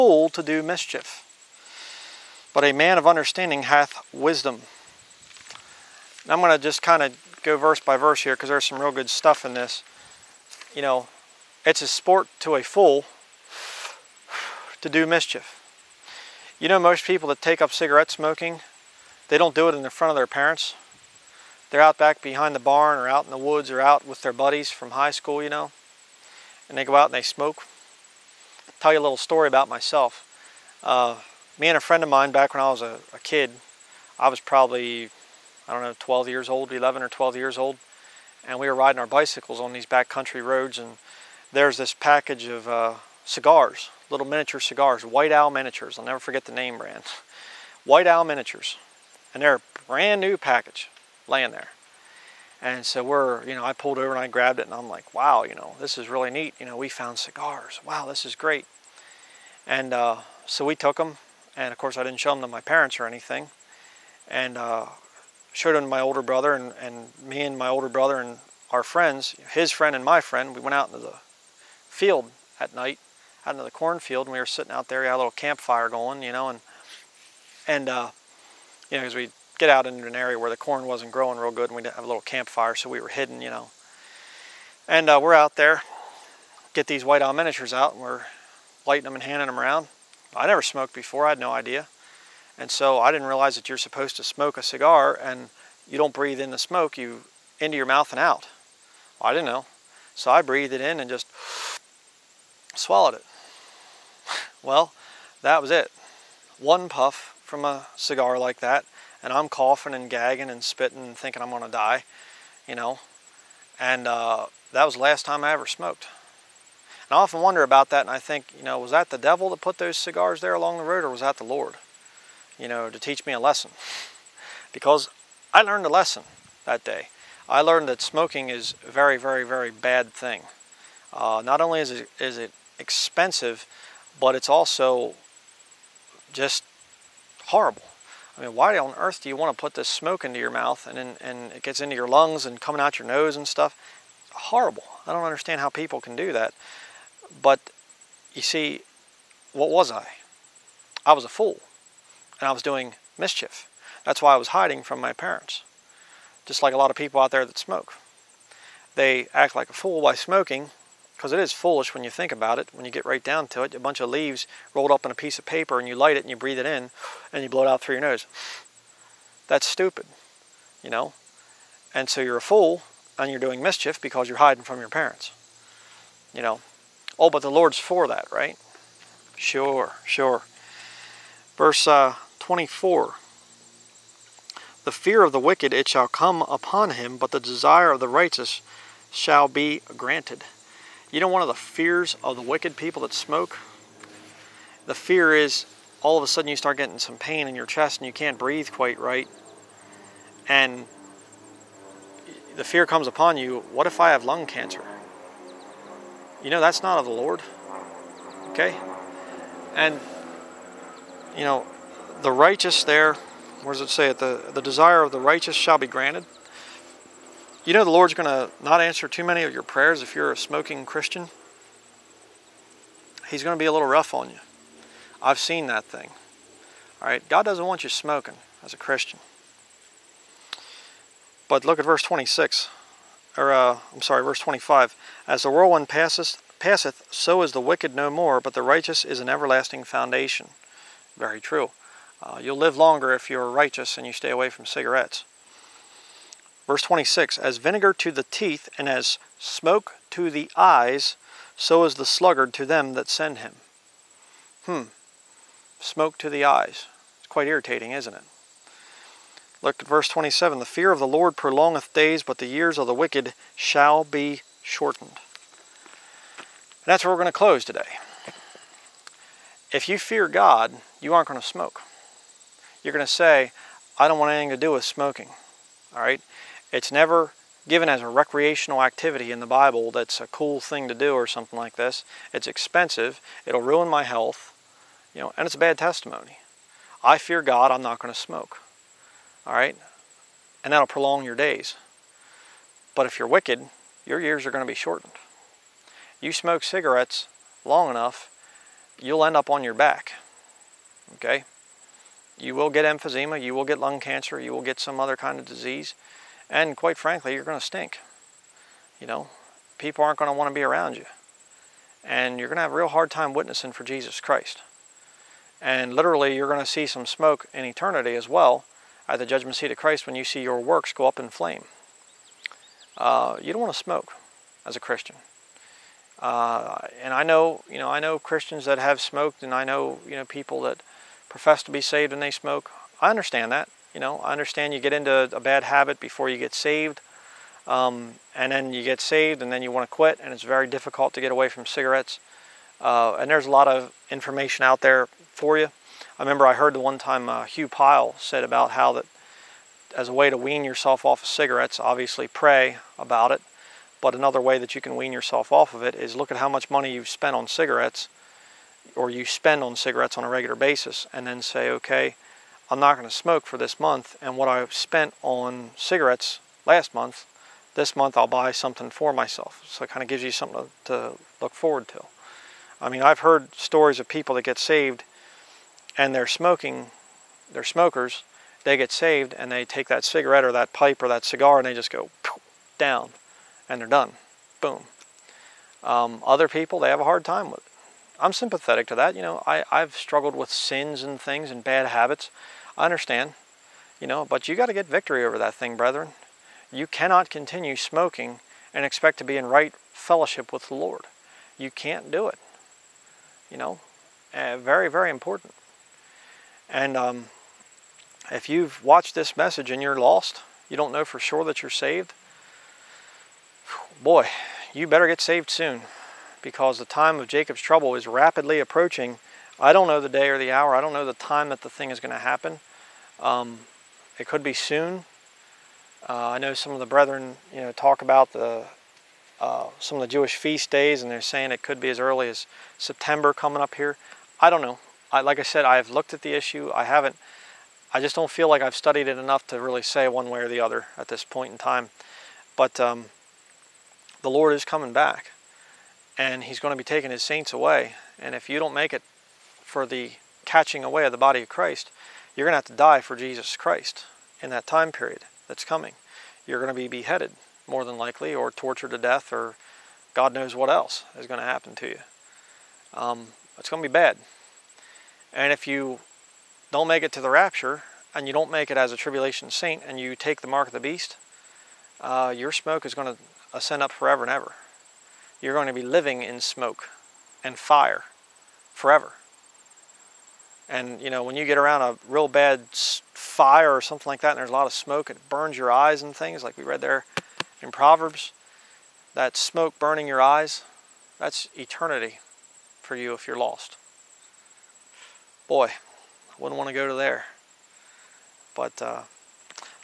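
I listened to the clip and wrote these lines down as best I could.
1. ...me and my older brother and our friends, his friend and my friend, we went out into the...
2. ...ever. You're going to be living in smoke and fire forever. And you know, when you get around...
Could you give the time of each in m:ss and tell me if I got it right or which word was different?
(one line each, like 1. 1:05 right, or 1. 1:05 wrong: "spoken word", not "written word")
1. 1:07 right
2. 7:54 right.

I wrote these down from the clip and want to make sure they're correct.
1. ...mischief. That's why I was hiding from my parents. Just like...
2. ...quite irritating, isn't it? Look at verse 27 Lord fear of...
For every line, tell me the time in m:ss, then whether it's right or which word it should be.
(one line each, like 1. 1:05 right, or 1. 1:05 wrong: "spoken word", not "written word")
1. 2:33 right
2. 4:17 wrong: "The", not "Lord".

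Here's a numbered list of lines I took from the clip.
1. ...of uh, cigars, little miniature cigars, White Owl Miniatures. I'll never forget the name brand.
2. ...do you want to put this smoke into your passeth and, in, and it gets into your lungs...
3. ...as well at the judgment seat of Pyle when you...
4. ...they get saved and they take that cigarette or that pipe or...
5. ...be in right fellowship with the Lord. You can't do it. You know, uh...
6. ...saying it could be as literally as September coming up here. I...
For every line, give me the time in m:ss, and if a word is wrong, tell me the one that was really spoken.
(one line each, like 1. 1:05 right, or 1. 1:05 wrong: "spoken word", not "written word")
1. 0:42 right
2. 2:19 wrong: "mouth", not "passeth"
3. 5:18 wrong: "Christ", not "Pyle"
4. 6:18 right
5. 6:39 right
6. 7:11 wrong: "early", not "literally".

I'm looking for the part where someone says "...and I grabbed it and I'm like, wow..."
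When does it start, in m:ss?
0:54.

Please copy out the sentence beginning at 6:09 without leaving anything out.
So it kind of gives you something to, to look forward to.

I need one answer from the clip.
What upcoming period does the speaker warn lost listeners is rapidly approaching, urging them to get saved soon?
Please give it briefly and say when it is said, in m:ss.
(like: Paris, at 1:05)
the time of Jacob's trouble, at 6:56.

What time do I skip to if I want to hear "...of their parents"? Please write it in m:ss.
0:20.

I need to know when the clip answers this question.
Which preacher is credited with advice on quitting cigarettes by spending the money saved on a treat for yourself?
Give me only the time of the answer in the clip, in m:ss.
5:47.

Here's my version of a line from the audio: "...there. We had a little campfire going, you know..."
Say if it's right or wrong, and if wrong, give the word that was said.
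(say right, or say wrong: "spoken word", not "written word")
right.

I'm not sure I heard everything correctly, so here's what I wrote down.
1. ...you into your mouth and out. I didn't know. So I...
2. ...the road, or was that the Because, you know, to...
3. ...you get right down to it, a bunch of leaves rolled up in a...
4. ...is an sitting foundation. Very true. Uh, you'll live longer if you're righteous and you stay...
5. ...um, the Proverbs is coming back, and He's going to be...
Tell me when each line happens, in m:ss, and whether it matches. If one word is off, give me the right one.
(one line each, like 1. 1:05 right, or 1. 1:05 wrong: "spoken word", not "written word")
1. 1:36 right
2. 2:00 wrong: "Lord", not "Because"
3. 2:42 right
4. 3:59 wrong: "everlasting", not "sitting"
5. 7:22 wrong: "Lord", not "Proverbs".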